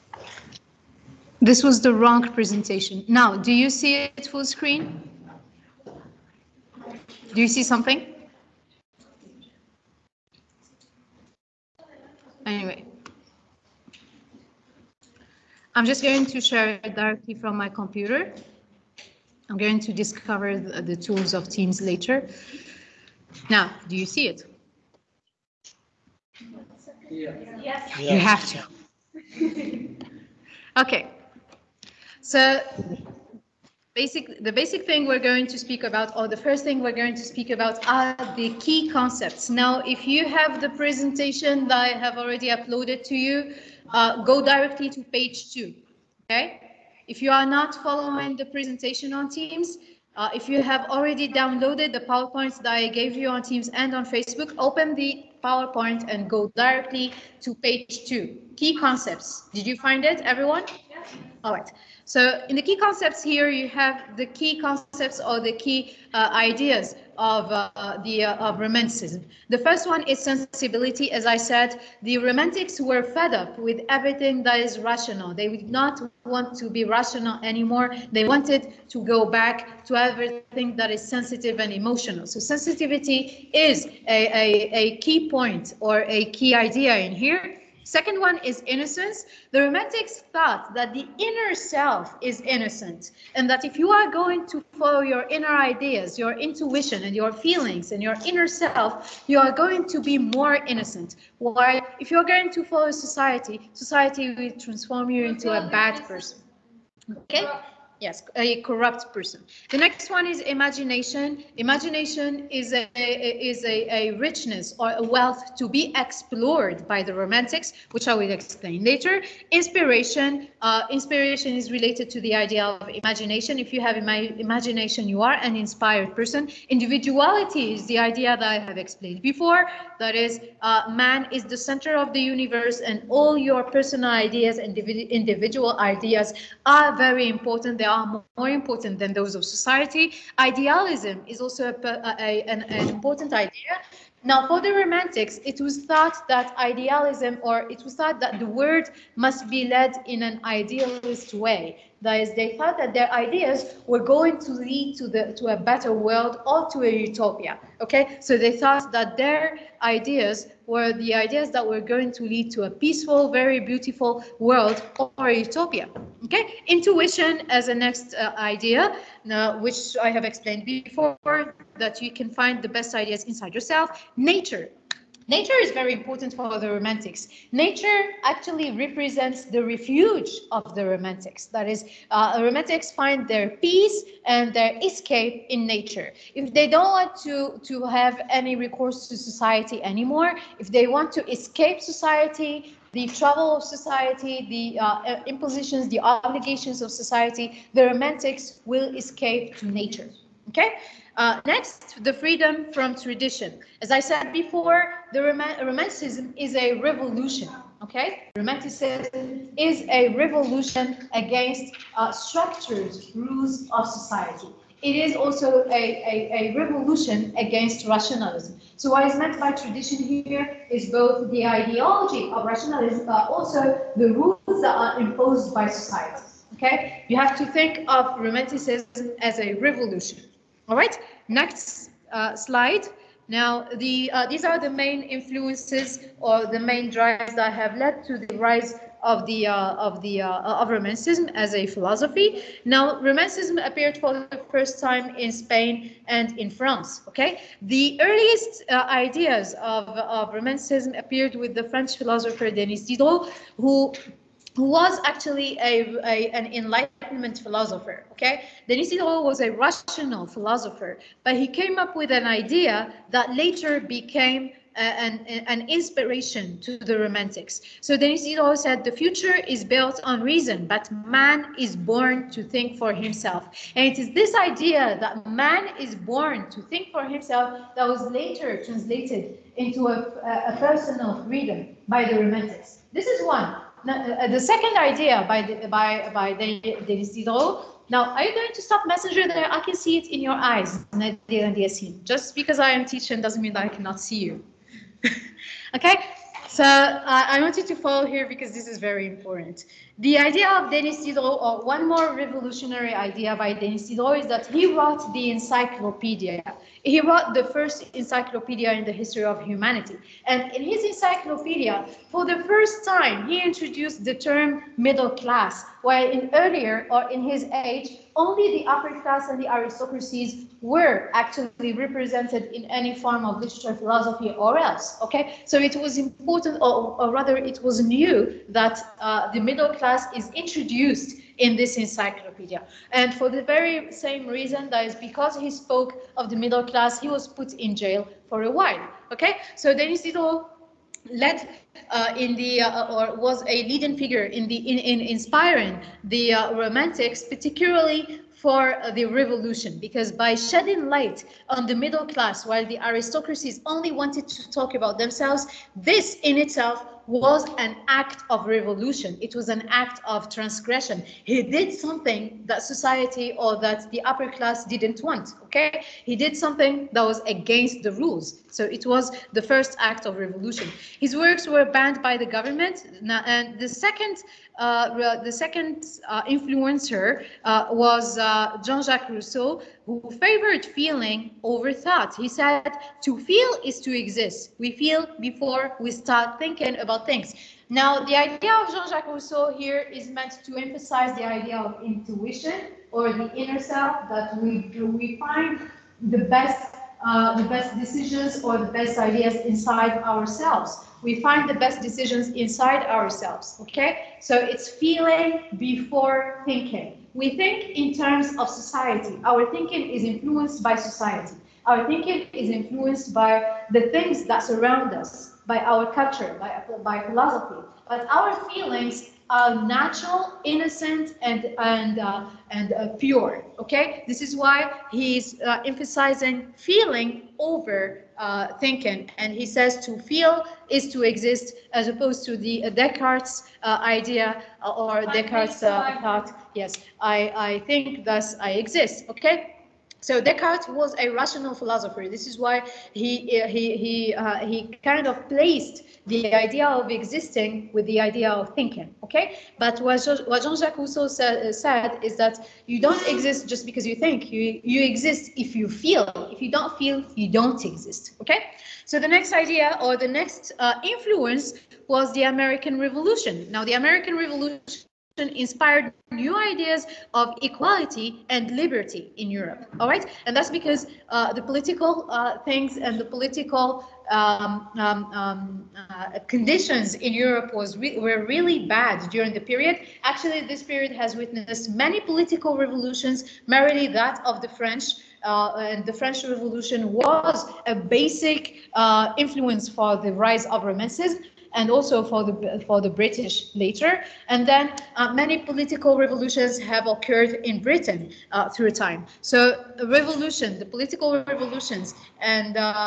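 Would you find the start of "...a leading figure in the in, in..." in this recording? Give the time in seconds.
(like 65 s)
343 s.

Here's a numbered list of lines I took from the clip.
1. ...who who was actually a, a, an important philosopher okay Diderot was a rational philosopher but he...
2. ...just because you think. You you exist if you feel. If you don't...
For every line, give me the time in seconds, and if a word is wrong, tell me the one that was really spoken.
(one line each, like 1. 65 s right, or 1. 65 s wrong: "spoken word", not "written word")
1. 253 s wrong: "enlightenment", not "important"
2. 453 s right.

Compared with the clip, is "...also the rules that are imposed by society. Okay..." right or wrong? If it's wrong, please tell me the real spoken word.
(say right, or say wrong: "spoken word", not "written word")
right.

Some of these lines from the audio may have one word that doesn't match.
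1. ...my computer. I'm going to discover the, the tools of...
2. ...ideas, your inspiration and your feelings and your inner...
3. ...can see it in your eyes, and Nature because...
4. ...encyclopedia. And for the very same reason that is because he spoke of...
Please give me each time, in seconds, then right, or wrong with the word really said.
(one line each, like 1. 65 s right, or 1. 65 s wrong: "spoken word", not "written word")
1. 17 s right
2. 95 s wrong: "intuition", not "inspiration"
3. 289 s wrong: "Just", not "Nature"
4. 331 s right.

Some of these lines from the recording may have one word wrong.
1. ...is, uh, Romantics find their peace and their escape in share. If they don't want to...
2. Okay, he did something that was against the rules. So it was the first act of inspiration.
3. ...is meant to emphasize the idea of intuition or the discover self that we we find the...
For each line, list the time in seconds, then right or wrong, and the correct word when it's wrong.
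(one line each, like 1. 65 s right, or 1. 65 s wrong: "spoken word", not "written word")
1. 181 s wrong: "nature", not "share"
2. 365 s wrong: "revolution", not "inspiration"
3. 389 s wrong: "inner", not "discover".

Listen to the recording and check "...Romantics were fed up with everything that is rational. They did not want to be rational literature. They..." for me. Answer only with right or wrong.
wrong.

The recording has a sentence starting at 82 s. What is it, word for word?
So sensitivity is a, a, a key point or a key idea in here.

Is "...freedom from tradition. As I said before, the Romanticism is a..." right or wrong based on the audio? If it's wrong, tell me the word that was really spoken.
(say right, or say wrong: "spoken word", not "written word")
right.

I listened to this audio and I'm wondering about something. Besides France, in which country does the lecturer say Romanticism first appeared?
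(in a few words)
Spain.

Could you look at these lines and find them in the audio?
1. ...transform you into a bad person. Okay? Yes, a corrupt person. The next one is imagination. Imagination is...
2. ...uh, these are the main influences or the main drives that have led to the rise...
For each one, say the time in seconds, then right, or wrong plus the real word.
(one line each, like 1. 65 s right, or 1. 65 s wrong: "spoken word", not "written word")
1. 104 s right
2. 234 s right.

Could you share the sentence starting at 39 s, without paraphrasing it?
Now, if you have the presentation that I have already uploaded to you, uh, go directly to page two, okay?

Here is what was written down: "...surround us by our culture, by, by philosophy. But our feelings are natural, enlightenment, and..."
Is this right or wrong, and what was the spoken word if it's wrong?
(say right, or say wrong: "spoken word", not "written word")
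wrong: "innocent", not "enlightenment".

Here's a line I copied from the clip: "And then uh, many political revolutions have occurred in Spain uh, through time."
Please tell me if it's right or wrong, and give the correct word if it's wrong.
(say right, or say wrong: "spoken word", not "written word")
wrong: "Britain", not "Spain".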